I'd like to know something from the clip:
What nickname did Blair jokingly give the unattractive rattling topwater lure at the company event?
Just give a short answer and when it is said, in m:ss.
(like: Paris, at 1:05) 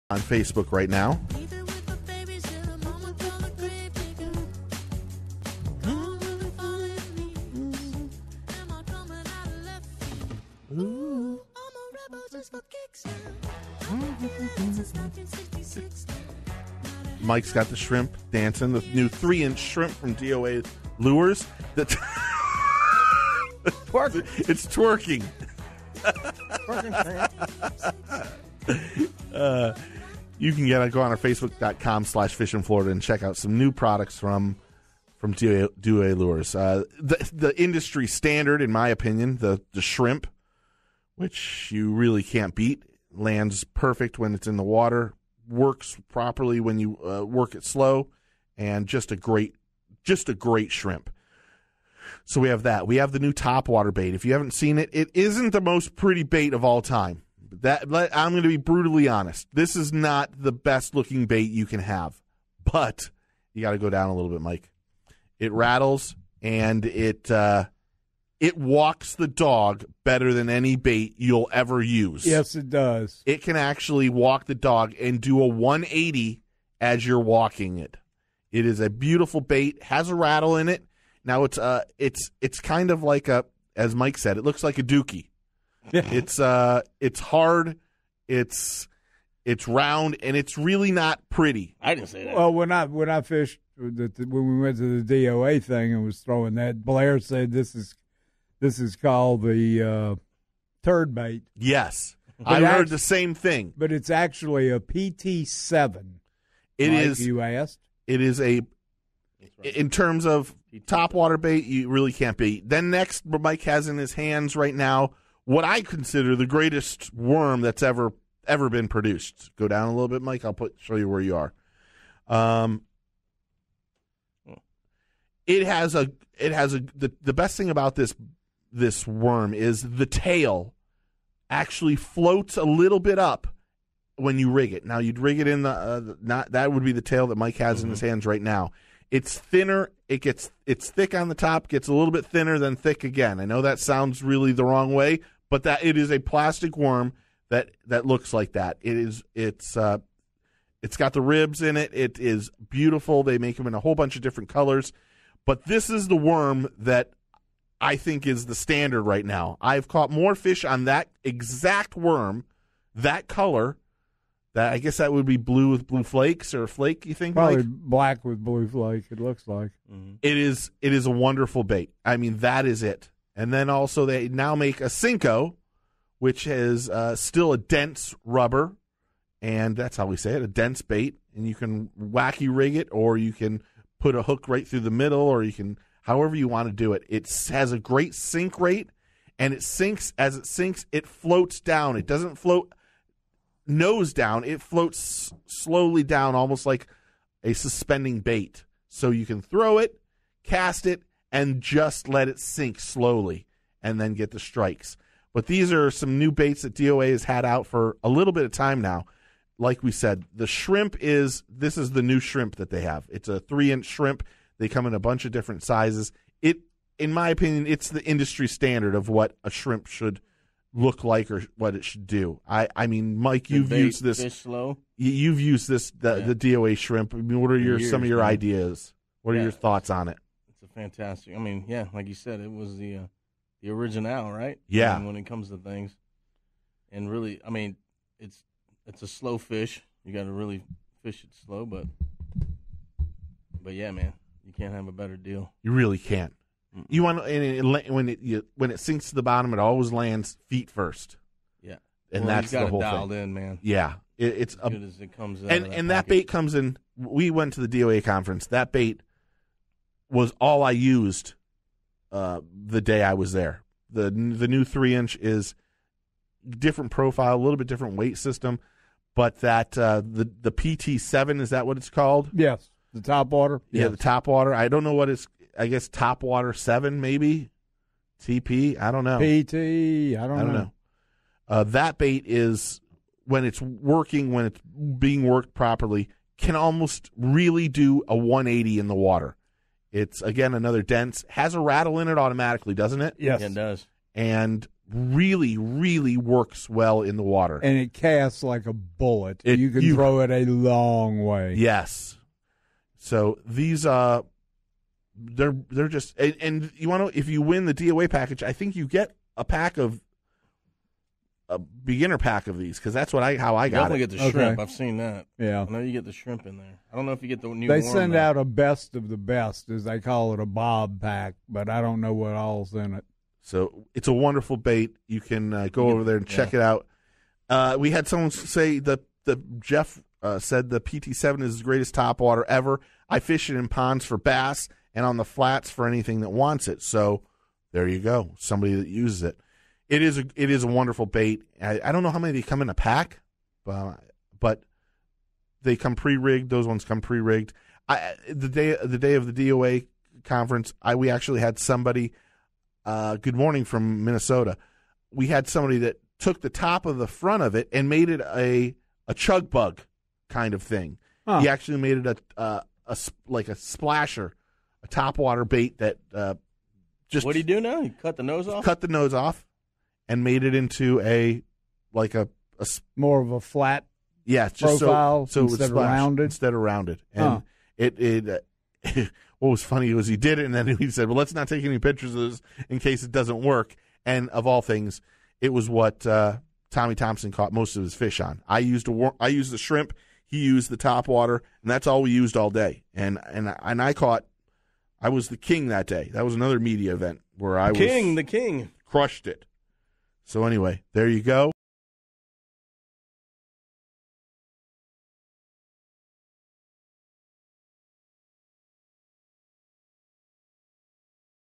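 turd bait, at 1:40.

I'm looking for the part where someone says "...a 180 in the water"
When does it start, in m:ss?
4:48.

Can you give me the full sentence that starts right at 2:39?
I've caught more fish on that exact worm, that color.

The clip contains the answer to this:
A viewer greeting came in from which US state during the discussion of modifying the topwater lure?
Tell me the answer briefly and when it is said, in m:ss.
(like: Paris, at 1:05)
Minnesota, at 5:54.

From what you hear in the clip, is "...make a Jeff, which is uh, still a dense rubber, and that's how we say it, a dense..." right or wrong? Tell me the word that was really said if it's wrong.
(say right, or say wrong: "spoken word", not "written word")
wrong: "Sinko", not "Jeff".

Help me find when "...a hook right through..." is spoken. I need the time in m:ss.
3:04.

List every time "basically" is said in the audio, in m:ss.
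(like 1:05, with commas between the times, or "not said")
not said.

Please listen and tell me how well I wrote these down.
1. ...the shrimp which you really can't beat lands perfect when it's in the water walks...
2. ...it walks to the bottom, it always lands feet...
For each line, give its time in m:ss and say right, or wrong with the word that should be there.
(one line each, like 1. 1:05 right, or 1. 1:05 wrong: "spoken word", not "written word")
1. 0:39 wrong: "works", not "walks"
2. 4:08 wrong: "sinks", not "walks".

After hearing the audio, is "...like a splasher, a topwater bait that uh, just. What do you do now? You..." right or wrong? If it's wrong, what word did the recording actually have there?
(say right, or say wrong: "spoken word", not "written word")
right.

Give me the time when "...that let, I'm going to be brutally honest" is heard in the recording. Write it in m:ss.
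0:57.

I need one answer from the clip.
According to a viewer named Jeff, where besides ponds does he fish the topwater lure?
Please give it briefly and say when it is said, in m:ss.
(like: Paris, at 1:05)
on the flats, at 5:35.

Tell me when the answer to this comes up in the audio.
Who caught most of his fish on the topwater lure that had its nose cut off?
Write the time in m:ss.
6:26.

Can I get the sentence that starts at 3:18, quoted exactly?
So you can throw it, cast it, and just let it sink slowly and then get the strikes.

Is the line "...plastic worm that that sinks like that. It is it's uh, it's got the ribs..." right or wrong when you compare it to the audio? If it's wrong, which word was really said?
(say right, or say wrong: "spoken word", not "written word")
wrong: "looks", not "sinks".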